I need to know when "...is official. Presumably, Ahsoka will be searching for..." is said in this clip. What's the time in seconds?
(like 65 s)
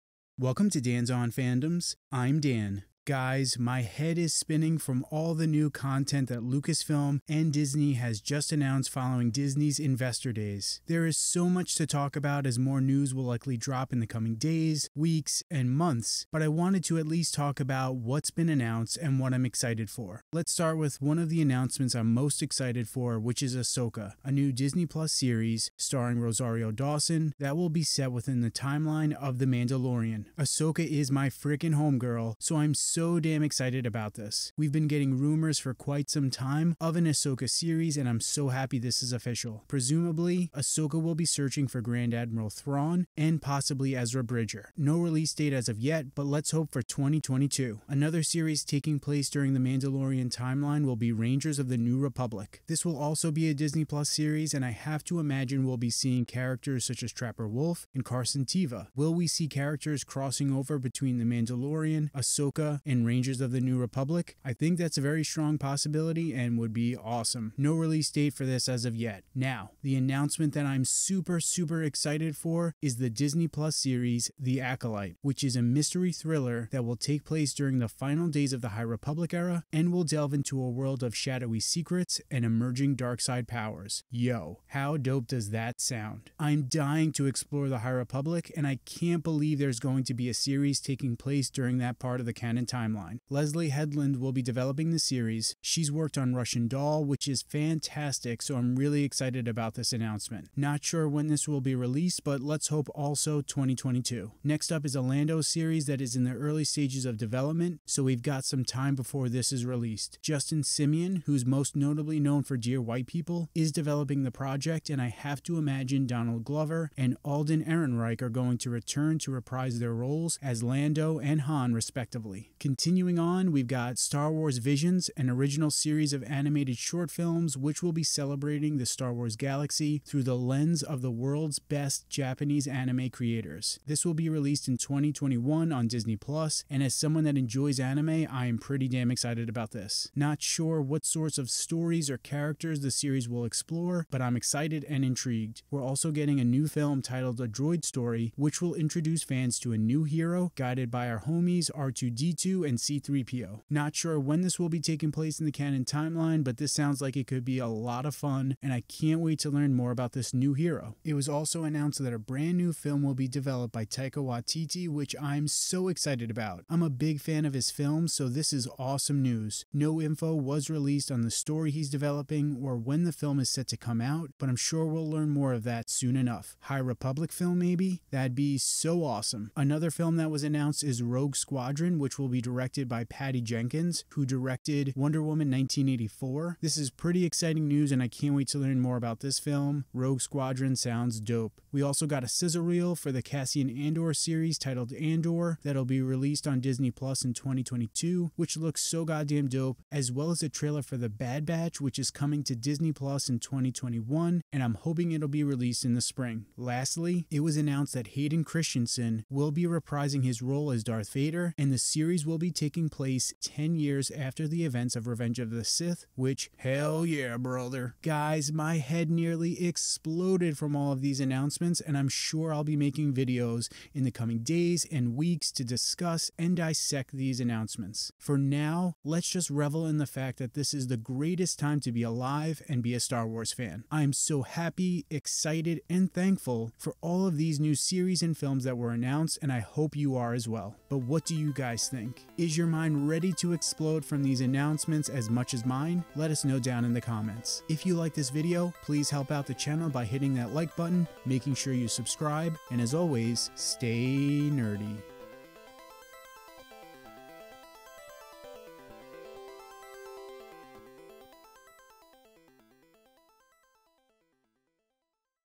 39 s.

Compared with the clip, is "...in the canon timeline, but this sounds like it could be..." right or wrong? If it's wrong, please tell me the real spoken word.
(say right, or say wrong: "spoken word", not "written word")
right.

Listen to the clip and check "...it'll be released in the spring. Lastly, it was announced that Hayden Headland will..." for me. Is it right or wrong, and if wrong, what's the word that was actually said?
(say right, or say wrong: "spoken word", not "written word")
wrong: "Christensen", not "Headland".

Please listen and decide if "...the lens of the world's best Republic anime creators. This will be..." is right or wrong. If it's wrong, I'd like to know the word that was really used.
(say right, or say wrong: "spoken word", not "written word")
wrong: "Japanese", not "Republic".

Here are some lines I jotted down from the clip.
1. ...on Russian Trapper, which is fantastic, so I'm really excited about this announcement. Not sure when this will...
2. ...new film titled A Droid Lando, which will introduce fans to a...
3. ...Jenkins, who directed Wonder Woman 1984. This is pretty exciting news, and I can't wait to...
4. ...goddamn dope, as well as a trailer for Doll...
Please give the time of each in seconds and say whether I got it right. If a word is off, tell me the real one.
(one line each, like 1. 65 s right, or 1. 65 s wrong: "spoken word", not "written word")
1. 96 s wrong: "Doll", not "Trapper"
2. 146 s wrong: "Story", not "Lando"
3. 183 s right
4. 199 s wrong: "The", not "Doll".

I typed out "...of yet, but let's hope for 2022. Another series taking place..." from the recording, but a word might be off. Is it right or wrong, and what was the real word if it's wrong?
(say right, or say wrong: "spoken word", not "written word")
right.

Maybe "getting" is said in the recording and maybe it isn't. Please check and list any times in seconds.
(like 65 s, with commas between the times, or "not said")
34 s, 146 s.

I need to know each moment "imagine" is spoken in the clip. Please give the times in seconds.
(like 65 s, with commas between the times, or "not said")
55 s, 115 s.